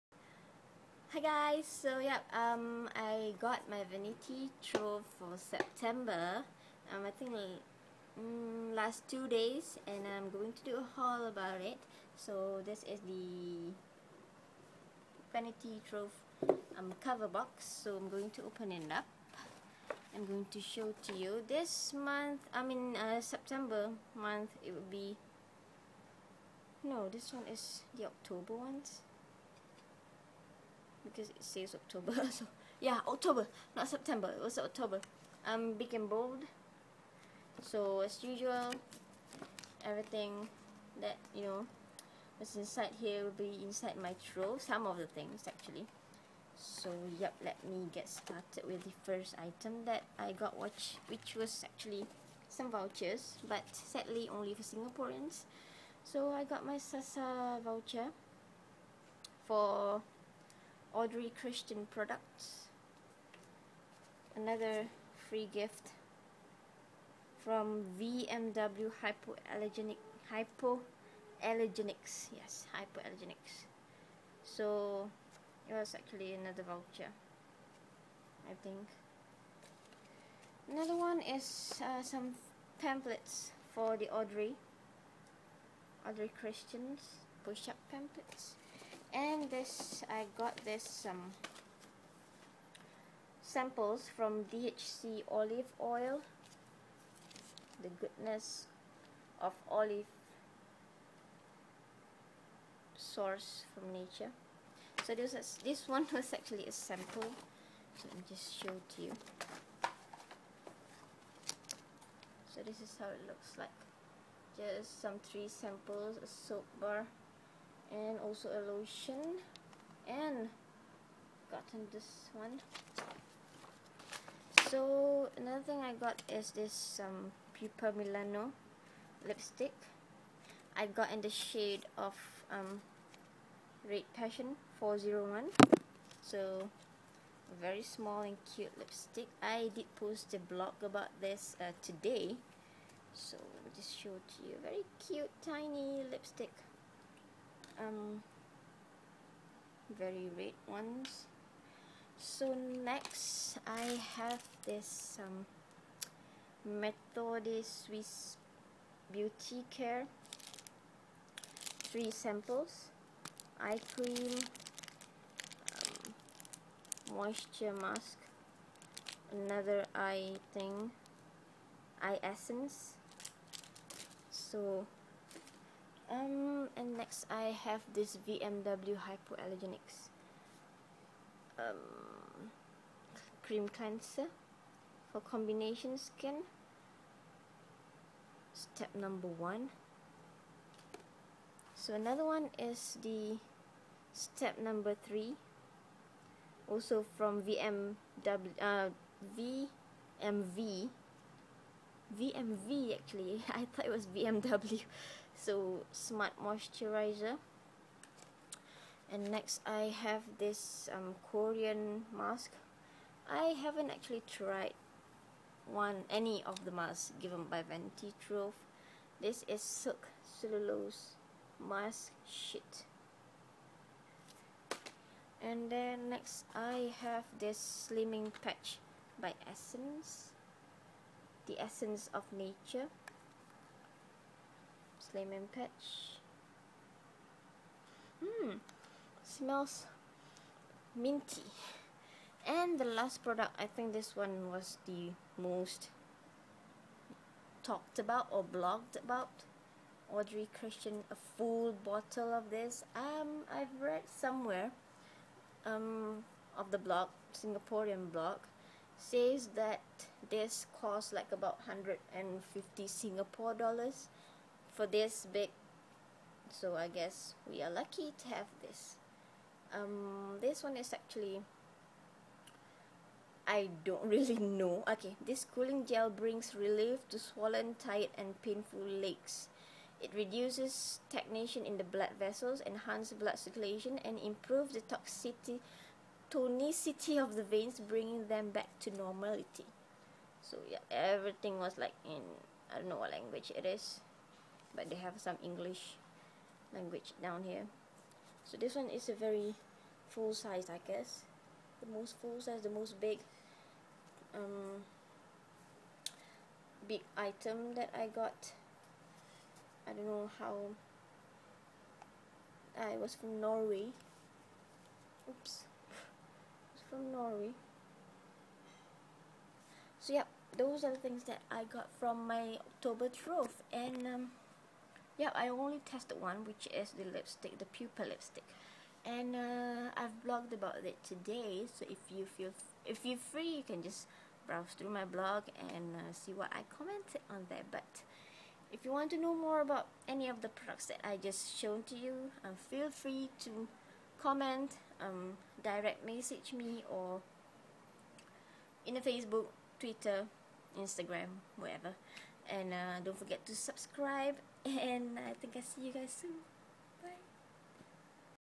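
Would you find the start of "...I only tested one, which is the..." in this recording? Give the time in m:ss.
5:25.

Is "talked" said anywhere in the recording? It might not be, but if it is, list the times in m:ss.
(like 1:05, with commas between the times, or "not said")
4:07.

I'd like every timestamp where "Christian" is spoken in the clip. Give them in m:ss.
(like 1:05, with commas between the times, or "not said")
1:01, 1:26, 4:10.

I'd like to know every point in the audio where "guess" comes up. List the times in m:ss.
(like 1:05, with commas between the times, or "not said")
4:26, 5:00.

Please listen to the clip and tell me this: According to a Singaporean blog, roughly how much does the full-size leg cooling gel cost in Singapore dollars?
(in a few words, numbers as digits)
150.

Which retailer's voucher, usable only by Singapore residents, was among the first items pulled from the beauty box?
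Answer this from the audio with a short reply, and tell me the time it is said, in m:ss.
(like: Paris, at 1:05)
Sasa, at 0:56.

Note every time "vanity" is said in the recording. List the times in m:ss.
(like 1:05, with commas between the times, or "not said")
0:03, 0:15, 3:37.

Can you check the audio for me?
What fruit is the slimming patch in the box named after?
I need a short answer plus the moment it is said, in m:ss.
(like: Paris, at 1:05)
lemon, at 3:55.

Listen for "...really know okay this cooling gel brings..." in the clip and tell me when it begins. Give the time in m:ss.
4:34.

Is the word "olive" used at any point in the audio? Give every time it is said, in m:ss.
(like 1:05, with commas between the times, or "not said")
1:35, 1:39.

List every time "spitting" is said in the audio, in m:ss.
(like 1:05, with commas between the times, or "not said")
not said.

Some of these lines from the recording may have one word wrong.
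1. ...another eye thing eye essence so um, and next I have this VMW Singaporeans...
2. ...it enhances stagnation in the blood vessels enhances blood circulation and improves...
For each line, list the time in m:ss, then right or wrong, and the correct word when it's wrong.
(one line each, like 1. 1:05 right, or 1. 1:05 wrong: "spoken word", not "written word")
1. 2:49 wrong: "Hypoallergenics", not "Singaporeans"
2. 4:40 wrong: "reduces", not "enhances".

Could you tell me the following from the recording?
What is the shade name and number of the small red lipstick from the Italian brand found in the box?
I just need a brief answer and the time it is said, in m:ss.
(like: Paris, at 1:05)
Red Passion 401, at 2:13.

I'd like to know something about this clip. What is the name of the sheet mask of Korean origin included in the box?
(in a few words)
silk cellulose mask sheet.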